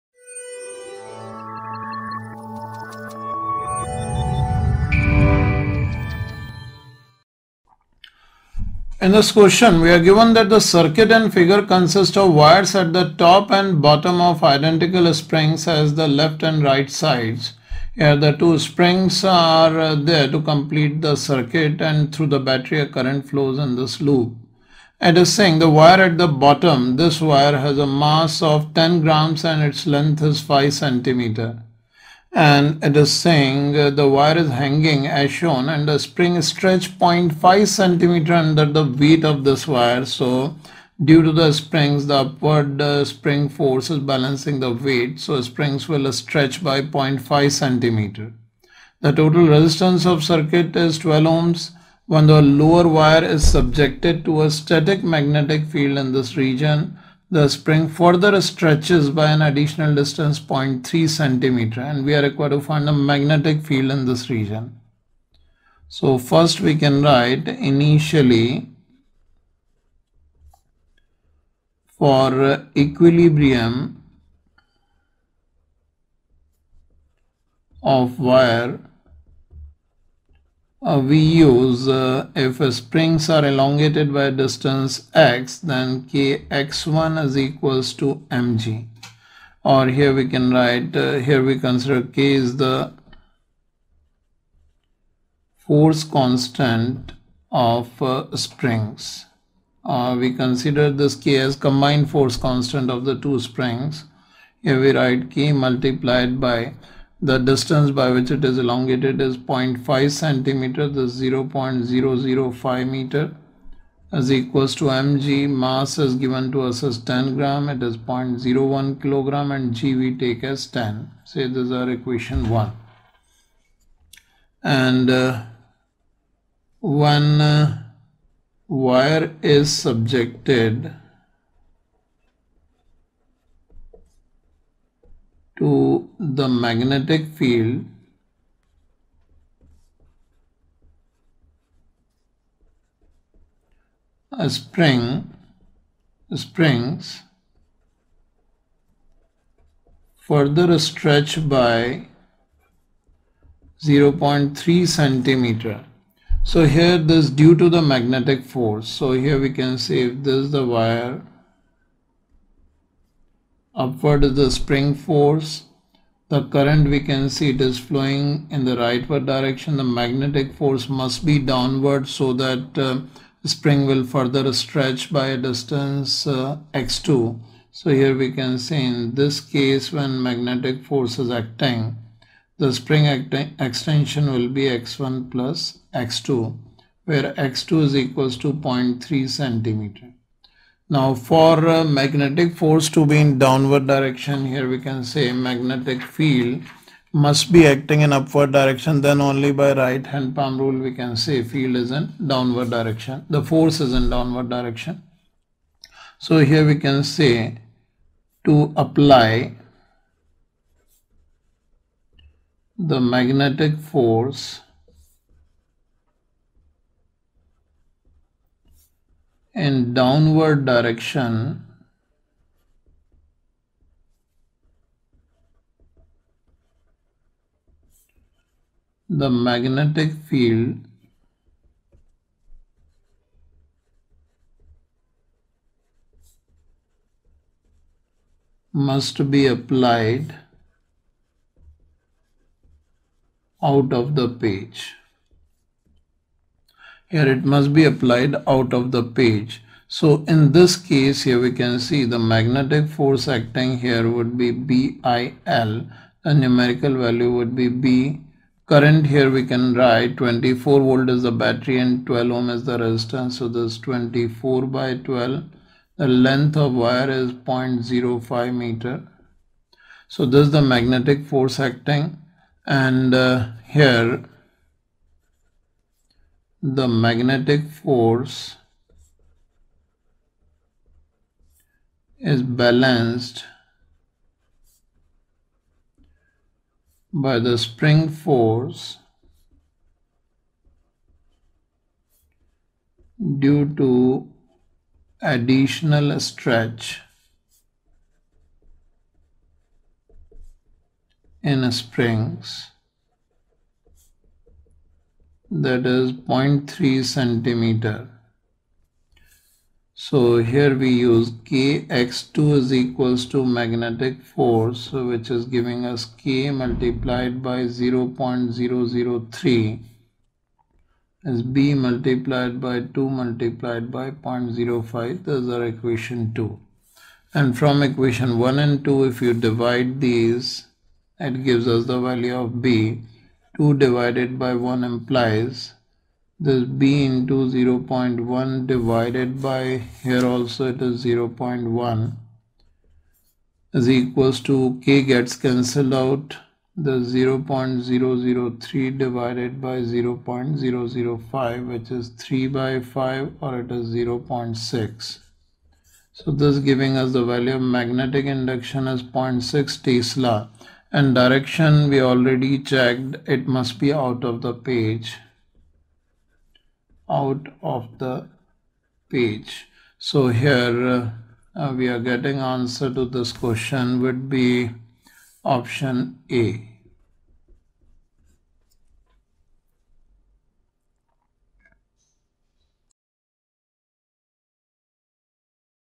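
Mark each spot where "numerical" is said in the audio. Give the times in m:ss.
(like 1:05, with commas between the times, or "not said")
4:16.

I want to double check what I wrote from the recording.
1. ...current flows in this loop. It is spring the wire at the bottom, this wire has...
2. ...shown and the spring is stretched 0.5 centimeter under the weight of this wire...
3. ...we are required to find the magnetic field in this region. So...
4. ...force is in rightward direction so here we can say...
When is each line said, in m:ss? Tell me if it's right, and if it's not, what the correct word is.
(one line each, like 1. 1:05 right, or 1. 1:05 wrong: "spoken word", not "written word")
1. 0:22 wrong: "saying", not "spring"
2. 0:35 right
3. 1:02 right
4. 3:23 wrong: "downward", not "rightward".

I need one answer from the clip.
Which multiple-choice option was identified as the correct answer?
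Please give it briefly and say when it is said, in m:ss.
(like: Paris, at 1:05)
Option A, at 6:15.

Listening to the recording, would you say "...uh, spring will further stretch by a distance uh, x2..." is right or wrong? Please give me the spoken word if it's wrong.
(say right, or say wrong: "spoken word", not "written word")
right.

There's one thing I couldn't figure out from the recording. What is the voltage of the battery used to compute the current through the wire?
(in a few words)
24 volt.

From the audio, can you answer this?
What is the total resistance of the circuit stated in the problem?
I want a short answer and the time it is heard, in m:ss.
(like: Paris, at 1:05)
12 ohms, at 0:50.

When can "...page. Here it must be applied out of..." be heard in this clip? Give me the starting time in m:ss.
4:04.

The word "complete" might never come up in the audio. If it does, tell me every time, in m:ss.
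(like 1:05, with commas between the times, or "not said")
0:20.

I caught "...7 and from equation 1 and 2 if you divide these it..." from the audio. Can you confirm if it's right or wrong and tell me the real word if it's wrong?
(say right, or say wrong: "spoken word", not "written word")
wrong: "2", not "7".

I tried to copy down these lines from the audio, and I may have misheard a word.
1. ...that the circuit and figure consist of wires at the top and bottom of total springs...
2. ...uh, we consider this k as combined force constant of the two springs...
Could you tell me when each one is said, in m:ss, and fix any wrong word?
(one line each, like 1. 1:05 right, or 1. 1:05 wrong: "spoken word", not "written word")
1. 0:10 wrong: "identical", not "total"
2. 1:39 right.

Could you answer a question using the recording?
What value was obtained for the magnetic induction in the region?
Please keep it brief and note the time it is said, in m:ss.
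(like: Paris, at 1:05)
0.6 tesla, at 5:59.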